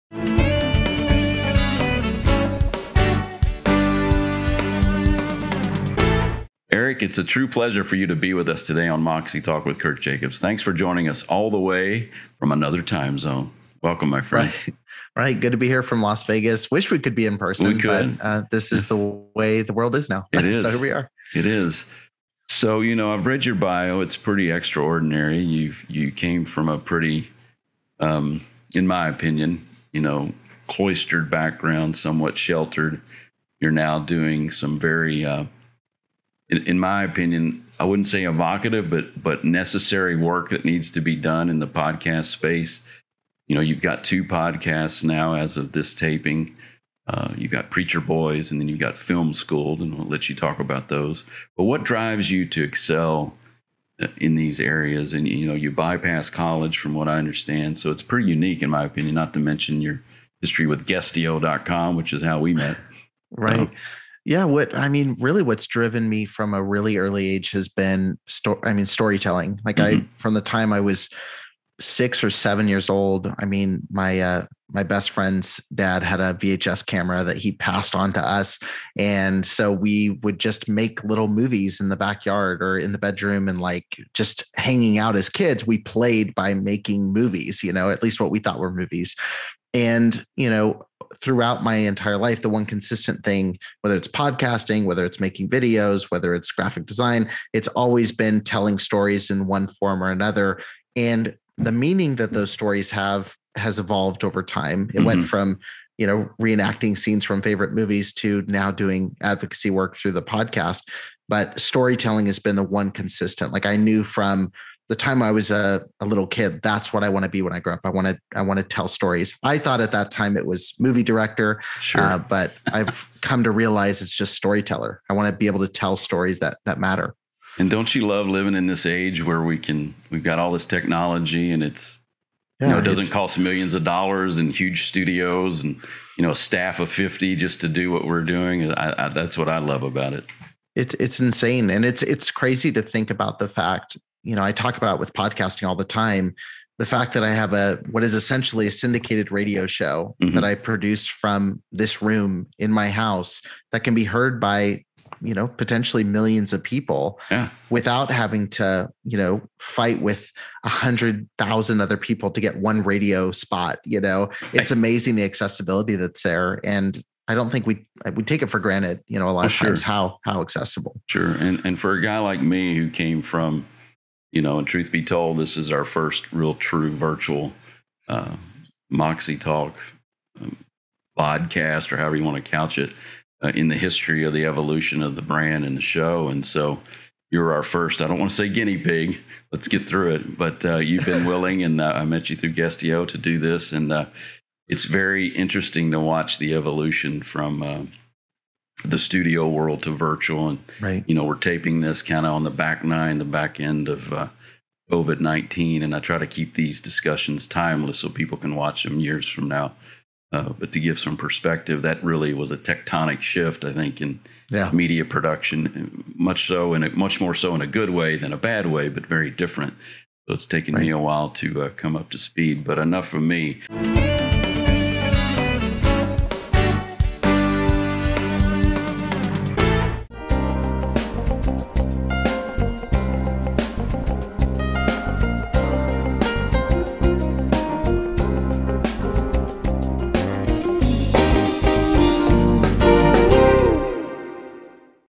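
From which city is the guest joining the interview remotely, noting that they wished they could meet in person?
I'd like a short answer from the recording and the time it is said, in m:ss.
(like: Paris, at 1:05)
Las Vegas, at 0:16.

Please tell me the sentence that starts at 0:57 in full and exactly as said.
So it's pretty unique, in my opinion.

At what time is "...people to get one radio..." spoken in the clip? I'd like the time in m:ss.
2:41.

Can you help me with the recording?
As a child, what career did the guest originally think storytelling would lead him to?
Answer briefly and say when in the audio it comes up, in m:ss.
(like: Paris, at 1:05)
Movie director, at 2:00.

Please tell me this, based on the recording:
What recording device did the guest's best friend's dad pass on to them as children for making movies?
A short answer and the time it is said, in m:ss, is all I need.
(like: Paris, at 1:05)
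VHS camera, at 1:16.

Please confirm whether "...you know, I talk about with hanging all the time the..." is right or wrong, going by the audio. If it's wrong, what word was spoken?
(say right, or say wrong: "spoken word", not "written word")
wrong: "podcasting", not "hanging".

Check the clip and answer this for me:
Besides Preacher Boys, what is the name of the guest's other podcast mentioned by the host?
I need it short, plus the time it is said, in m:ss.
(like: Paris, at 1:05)
Film School'd, at 0:48.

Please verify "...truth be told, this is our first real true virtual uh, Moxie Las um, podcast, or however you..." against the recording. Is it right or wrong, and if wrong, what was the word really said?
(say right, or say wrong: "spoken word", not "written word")
wrong: "Talk", not "Las".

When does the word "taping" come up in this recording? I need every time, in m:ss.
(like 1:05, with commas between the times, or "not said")
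0:45, 3:21.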